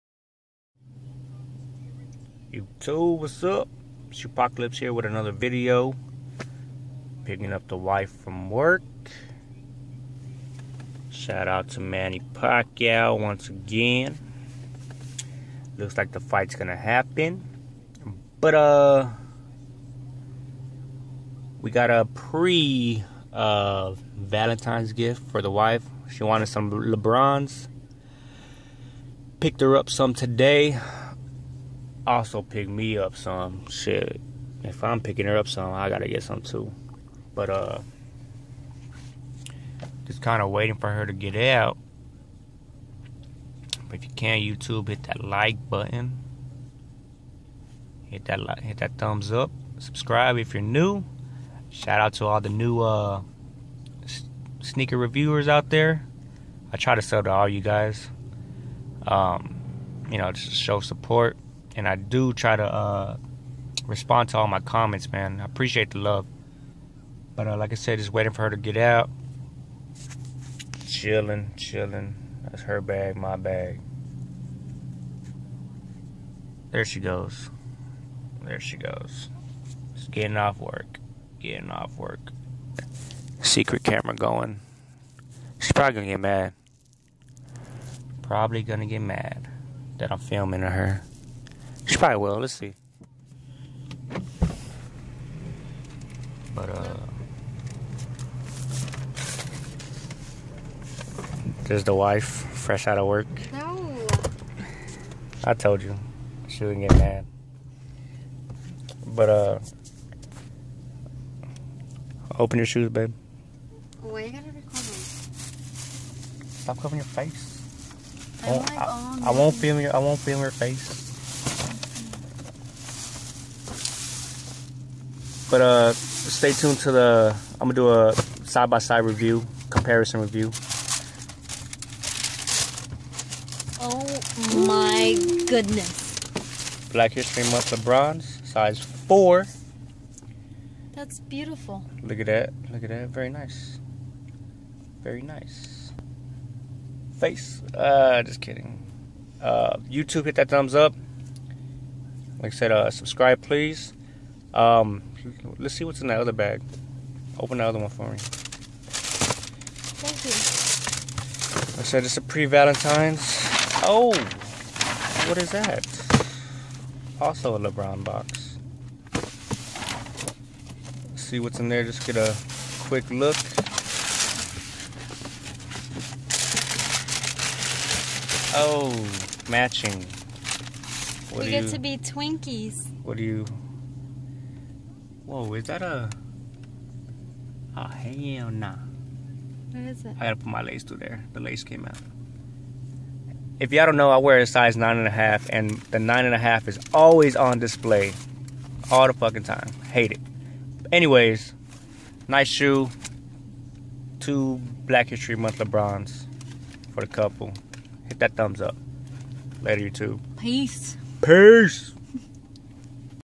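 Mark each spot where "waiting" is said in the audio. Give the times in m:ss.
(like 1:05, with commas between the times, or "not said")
0:40, 1:08.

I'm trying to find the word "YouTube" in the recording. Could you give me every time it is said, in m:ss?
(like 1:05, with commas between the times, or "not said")
0:02, 0:44, 2:29, 3:29.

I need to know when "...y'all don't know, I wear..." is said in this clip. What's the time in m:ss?
3:13.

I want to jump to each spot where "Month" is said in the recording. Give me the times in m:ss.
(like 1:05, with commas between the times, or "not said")
2:17, 3:25.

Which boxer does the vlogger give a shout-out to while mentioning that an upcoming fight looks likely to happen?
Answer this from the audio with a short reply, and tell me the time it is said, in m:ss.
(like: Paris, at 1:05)
Manny Pacquiao, at 0:11.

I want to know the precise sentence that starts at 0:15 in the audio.
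Looks like the fight's gonna happen.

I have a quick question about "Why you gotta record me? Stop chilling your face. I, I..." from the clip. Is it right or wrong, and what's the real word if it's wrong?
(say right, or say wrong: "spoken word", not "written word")
wrong: "covering", not "chilling".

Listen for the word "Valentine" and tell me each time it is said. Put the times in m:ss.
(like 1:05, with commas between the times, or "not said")
0:24, 2:42.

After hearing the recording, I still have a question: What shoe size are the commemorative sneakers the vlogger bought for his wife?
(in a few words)
4.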